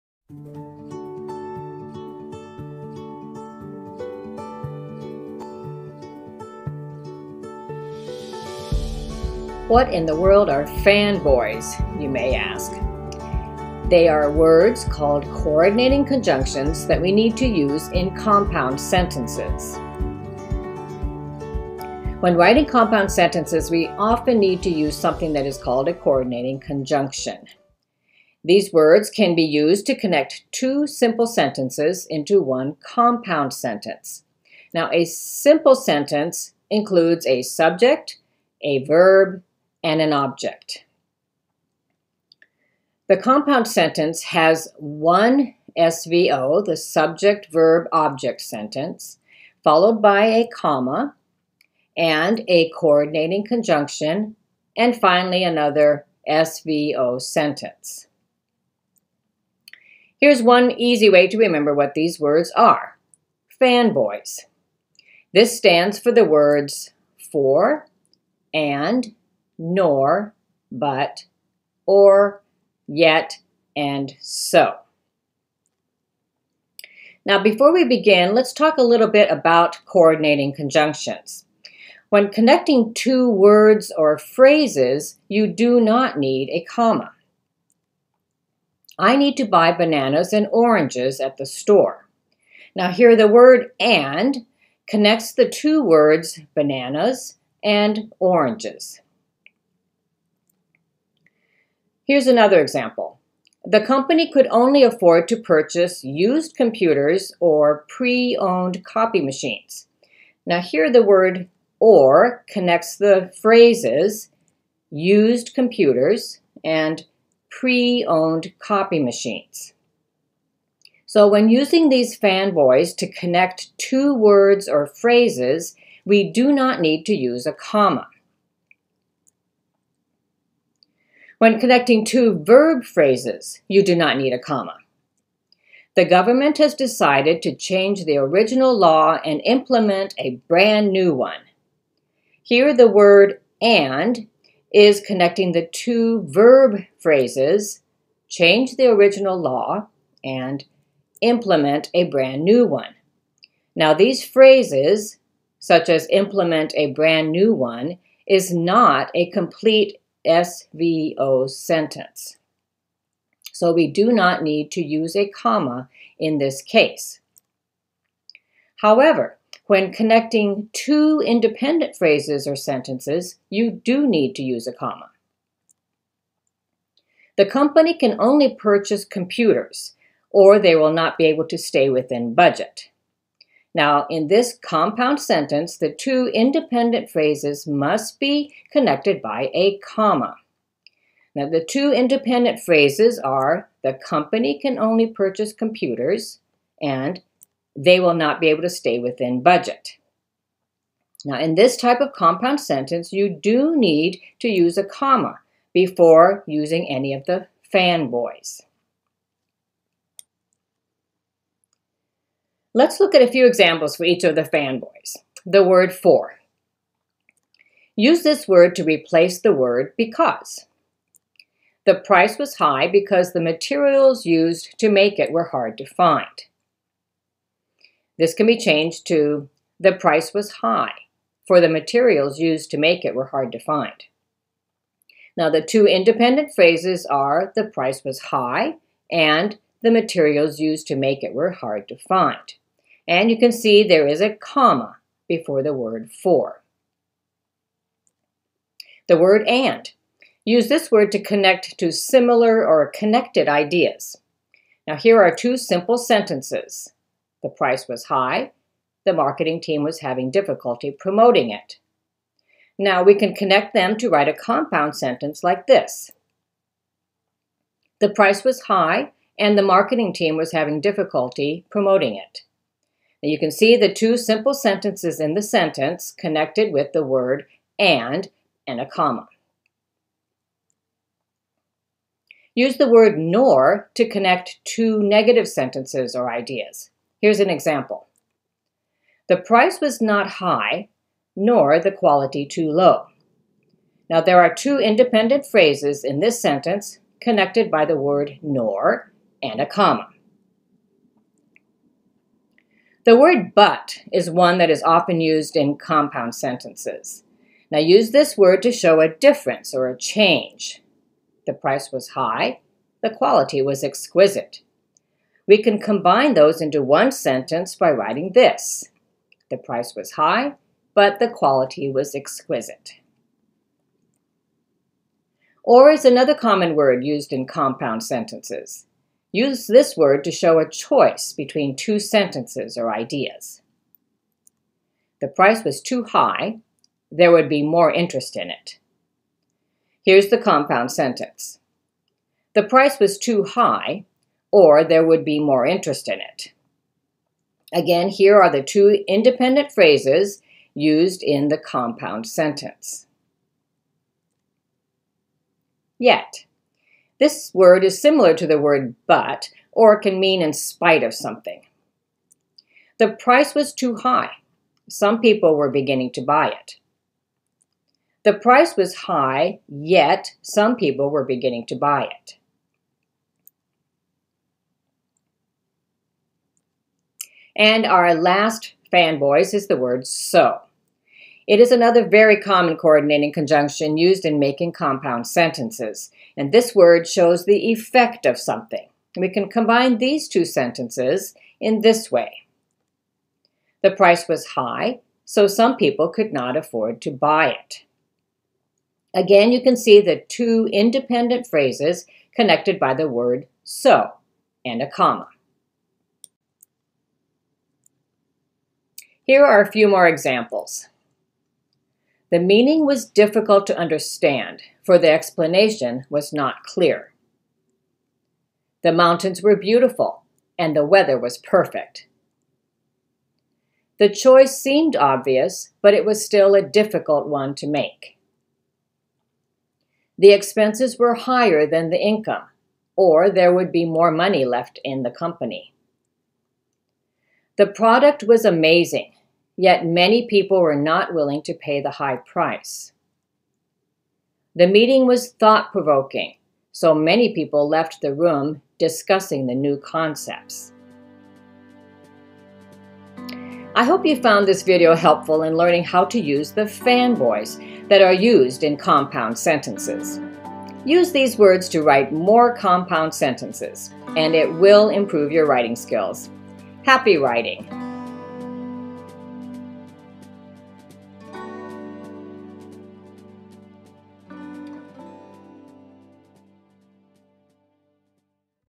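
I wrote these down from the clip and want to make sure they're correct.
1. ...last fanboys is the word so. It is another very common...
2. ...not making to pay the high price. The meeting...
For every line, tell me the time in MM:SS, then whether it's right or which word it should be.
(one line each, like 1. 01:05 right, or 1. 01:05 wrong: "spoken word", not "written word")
1. 06:18 right
2. 07:20 wrong: "willing", not "making".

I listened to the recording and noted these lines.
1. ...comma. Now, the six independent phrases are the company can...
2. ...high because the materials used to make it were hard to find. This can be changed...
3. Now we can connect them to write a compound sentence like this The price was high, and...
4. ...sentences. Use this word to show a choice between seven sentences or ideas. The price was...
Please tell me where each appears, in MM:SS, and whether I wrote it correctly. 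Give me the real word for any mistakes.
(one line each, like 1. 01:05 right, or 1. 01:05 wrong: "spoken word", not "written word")
1. 03:09 wrong: "two", not "six"
2. 03:42 right
3. 04:22 right
4. 05:28 wrong: "two", not "seven".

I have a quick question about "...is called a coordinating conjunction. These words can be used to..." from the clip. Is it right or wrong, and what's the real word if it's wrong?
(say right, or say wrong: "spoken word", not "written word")
right.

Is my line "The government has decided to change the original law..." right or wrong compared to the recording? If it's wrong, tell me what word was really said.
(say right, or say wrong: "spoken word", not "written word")
right.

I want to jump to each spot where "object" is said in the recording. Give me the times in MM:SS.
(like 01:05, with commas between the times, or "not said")
00:40, 00:47.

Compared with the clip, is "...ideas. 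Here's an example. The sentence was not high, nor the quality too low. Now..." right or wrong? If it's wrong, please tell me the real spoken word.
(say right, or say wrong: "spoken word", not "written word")
wrong: "price", not "sentence".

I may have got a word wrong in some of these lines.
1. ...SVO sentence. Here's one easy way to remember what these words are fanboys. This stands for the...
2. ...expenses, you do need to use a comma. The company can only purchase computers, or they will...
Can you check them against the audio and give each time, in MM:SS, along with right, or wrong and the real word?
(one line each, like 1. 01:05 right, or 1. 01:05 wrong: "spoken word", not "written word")
1. 00:56 right
2. 02:52 wrong: "sentences", not "expenses".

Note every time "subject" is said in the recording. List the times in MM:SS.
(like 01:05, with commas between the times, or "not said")
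00:37, 00:46.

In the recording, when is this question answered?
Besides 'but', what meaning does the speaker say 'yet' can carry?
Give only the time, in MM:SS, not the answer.
06:00.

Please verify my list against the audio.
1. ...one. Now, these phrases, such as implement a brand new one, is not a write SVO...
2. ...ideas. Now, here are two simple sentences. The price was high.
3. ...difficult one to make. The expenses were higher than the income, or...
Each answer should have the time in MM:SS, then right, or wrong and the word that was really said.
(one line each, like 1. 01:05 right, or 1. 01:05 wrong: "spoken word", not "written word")
1. 02:32 wrong: "complete", not "write"
2. 04:13 right
3. 07:06 right.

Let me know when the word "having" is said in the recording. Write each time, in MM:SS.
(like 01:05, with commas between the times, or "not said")
04:20, 04:30.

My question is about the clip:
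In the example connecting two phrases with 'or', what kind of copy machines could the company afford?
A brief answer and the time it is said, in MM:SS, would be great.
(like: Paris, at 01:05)
pre-owned, at 01:47.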